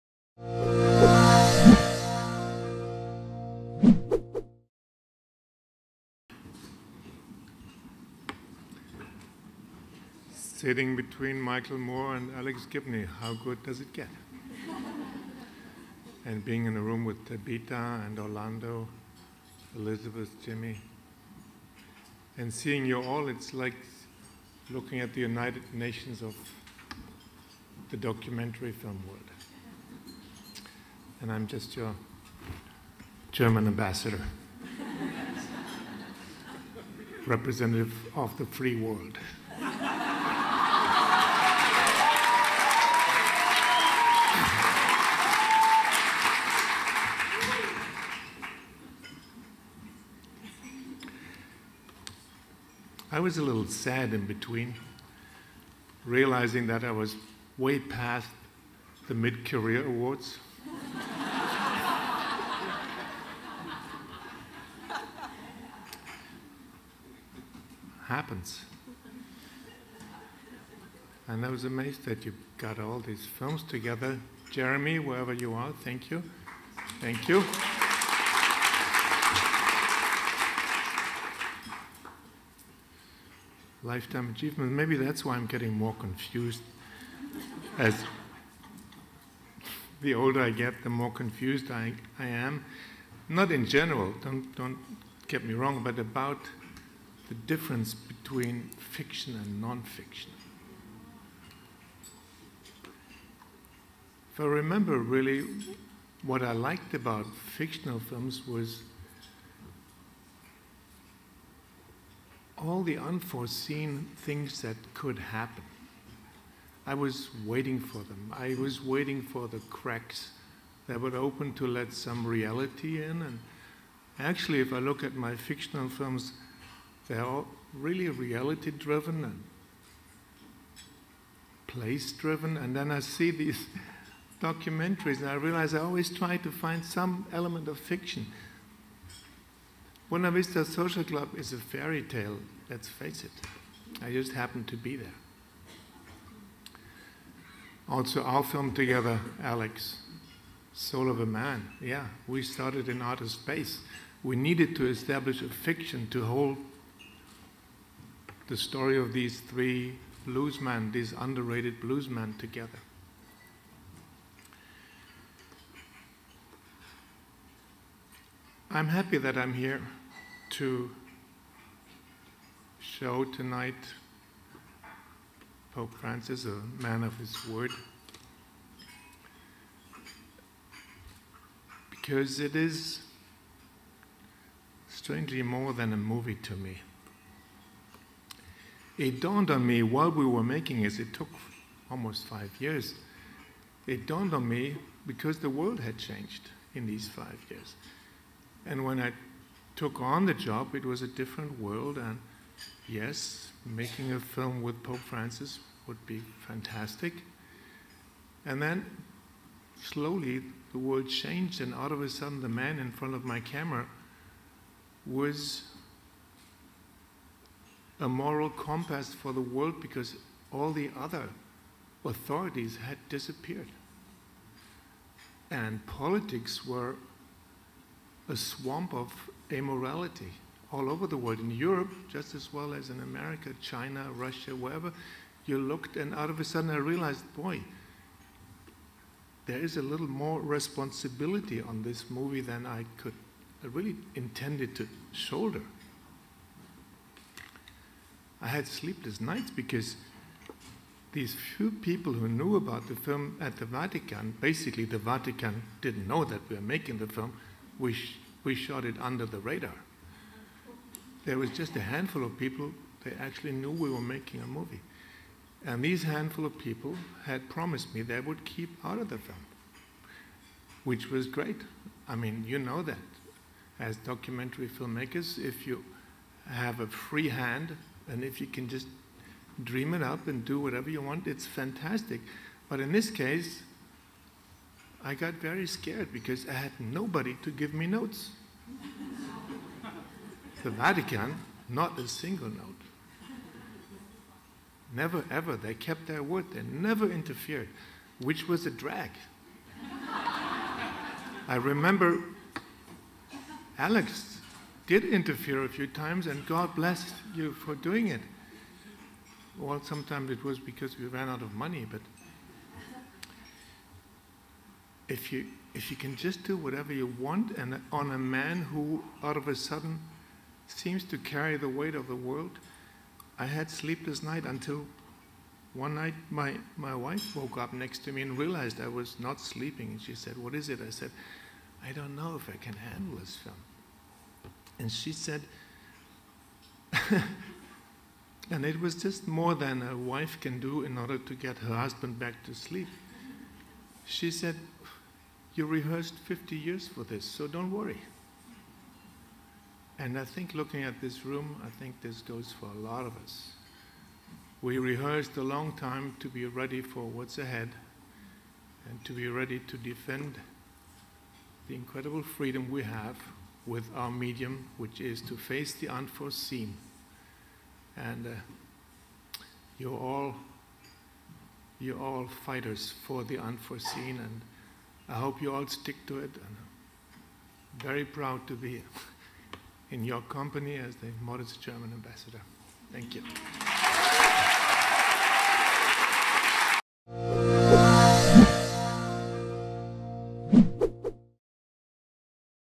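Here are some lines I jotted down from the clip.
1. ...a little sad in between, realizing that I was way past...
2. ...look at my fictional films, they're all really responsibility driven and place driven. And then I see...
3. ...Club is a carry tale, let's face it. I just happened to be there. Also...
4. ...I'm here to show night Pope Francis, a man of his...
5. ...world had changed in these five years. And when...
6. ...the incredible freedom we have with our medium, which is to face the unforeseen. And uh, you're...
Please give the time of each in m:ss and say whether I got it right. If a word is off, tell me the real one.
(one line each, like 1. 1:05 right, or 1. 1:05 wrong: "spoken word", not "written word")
1. 0:53 right
2. 2:04 wrong: "reality", not "responsibility"
3. 2:21 wrong: "fairy", not "carry"
4. 2:49 wrong: "tonight", not "night"
5. 3:15 right
6. 6:01 right.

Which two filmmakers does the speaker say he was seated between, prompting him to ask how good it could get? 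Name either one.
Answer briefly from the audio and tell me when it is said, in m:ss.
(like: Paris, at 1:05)
Michael Moore, at 0:11.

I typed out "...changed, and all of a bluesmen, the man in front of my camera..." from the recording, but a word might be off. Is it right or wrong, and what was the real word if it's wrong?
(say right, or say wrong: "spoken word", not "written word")
wrong: "sudden", not "bluesmen".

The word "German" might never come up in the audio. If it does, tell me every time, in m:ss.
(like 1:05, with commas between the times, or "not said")
0:33, 6:21.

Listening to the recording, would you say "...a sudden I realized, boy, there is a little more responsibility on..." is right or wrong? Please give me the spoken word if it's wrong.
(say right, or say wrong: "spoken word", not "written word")
right.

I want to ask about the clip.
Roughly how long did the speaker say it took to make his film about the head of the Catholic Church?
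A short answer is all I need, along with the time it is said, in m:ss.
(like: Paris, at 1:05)
Almost 5 years, at 3:11.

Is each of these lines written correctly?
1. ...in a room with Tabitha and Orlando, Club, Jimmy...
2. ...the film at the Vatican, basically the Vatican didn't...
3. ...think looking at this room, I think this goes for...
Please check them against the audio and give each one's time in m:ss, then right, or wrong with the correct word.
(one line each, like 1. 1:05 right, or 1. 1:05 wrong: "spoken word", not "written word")
1. 0:16 wrong: "Elizabeth", not "Club"
2. 4:12 right
3. 5:50 right.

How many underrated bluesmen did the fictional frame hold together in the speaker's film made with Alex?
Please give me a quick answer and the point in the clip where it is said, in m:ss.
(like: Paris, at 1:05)
3, at 2:39.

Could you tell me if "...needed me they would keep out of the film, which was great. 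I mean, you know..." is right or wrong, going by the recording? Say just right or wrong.
wrong.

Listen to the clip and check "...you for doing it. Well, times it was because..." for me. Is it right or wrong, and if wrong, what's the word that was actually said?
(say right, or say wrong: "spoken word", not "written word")
wrong: "sometimes", not "times".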